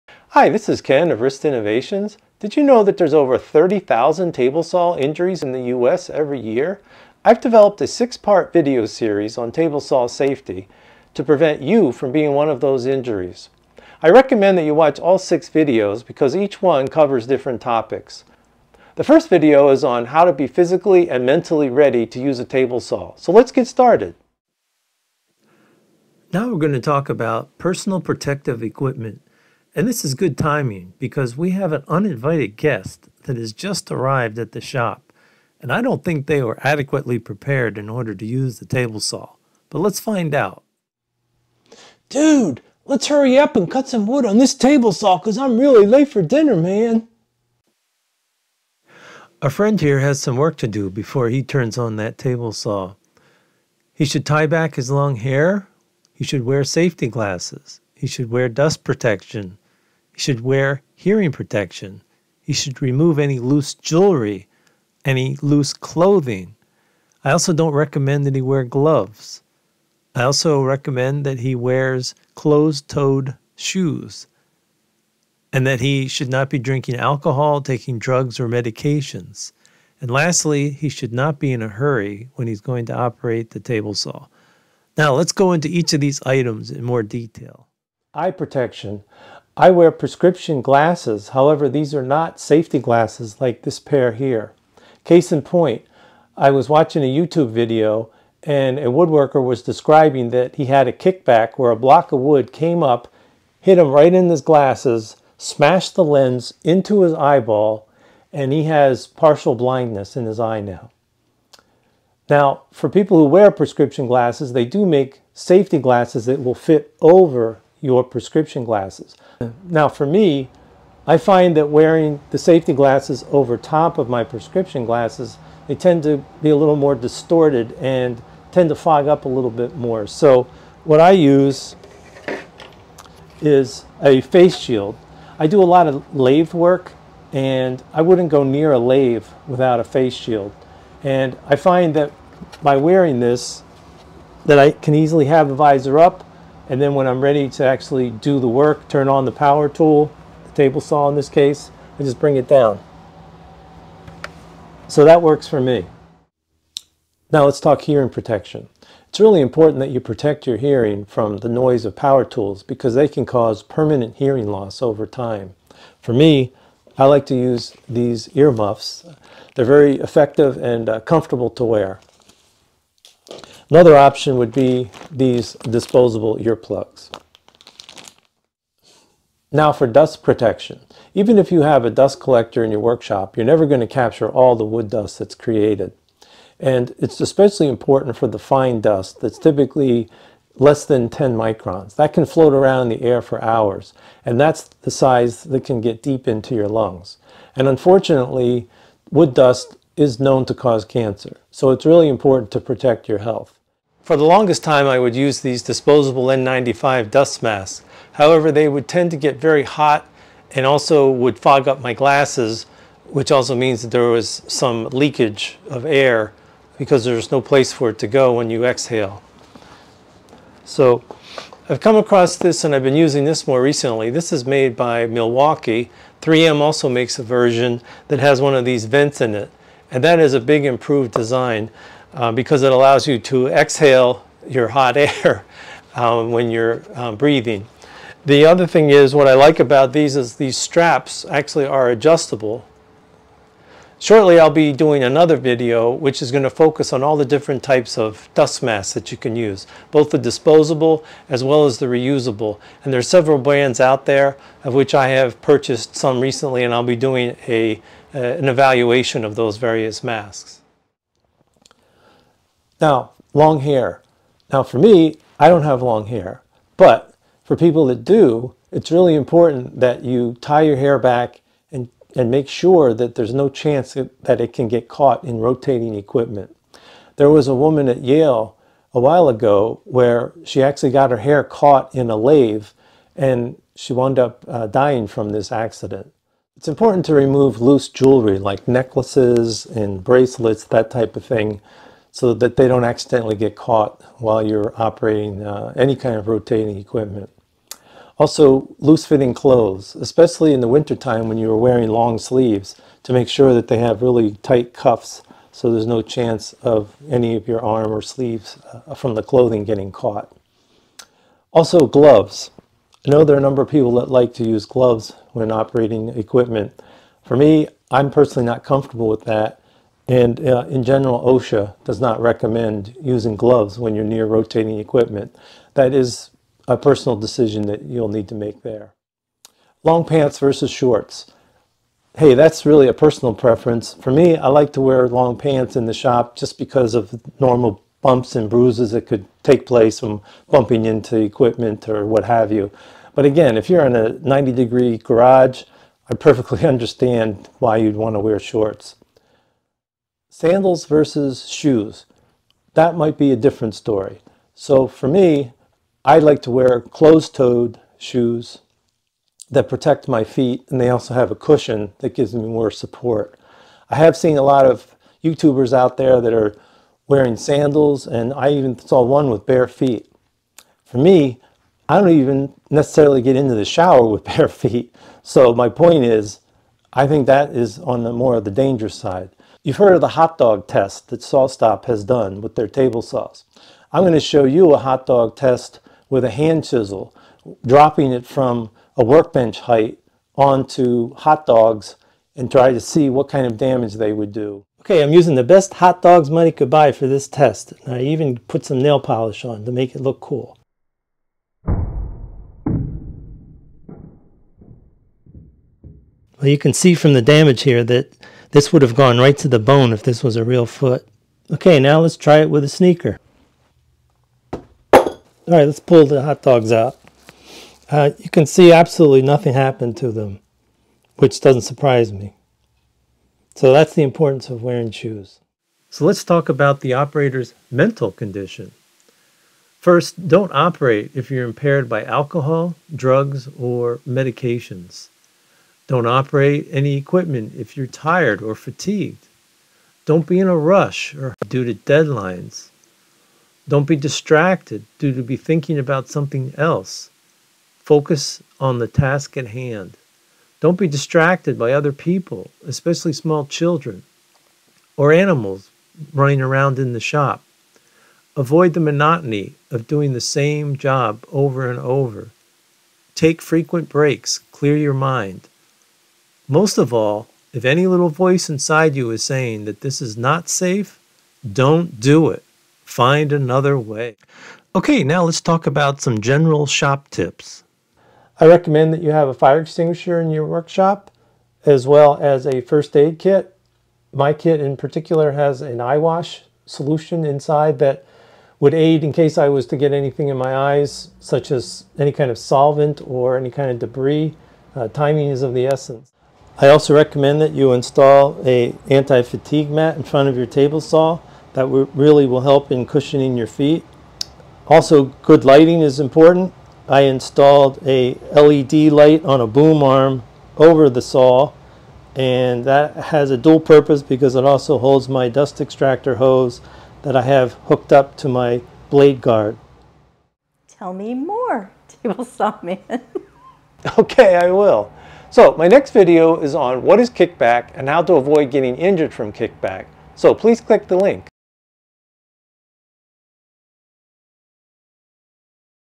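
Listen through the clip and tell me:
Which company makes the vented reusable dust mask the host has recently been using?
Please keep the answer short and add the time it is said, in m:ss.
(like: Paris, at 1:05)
Milwaukee, at 3:45.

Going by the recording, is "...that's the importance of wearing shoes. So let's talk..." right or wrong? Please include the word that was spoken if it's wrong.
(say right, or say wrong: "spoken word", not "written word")
right.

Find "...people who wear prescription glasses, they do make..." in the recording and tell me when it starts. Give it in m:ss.
1:52.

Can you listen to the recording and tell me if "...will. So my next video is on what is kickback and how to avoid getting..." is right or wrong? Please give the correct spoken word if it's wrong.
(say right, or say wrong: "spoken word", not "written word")
right.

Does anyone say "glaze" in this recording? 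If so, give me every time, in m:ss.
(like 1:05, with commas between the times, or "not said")
not said.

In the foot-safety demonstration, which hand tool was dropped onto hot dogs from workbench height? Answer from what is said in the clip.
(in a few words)
hand chisel.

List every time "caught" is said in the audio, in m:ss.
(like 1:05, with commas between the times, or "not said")
4:34, 4:41, 4:53, 5:09.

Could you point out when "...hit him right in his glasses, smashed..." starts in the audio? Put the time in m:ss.
1:43.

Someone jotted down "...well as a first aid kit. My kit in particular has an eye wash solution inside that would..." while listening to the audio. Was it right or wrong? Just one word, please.
right.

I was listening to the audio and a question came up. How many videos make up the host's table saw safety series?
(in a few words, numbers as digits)
6.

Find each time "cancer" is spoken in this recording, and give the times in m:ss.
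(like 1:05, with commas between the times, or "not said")
3:20.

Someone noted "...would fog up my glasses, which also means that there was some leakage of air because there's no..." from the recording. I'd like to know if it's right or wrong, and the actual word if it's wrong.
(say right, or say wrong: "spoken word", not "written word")
right.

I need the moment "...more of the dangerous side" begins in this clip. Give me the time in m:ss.
6:18.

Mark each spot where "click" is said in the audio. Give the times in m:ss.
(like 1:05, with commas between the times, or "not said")
8:50.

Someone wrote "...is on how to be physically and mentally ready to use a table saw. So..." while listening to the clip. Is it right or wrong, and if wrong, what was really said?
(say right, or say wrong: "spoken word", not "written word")
right.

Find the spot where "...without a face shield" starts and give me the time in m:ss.
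2:19.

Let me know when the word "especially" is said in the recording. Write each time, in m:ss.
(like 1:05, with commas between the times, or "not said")
3:07, 4:59, 7:32.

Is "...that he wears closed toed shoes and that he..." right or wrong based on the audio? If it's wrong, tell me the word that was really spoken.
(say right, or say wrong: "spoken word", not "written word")
right.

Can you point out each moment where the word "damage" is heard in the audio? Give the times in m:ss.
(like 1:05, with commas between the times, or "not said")
6:33, 6:47.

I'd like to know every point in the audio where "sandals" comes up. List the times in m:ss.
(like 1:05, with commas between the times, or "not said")
5:50, 6:07.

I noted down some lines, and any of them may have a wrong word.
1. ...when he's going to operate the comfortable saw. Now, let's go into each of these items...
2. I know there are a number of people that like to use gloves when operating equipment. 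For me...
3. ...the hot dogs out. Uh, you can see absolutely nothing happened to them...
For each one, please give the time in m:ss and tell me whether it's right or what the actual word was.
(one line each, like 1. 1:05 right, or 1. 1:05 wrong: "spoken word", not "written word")
1. 1:22 wrong: "table", not "comfortable"
2. 5:13 right
3. 6:56 right.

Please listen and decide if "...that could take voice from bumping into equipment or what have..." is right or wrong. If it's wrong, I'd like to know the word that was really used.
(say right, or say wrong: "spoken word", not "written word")
wrong: "place", not "voice".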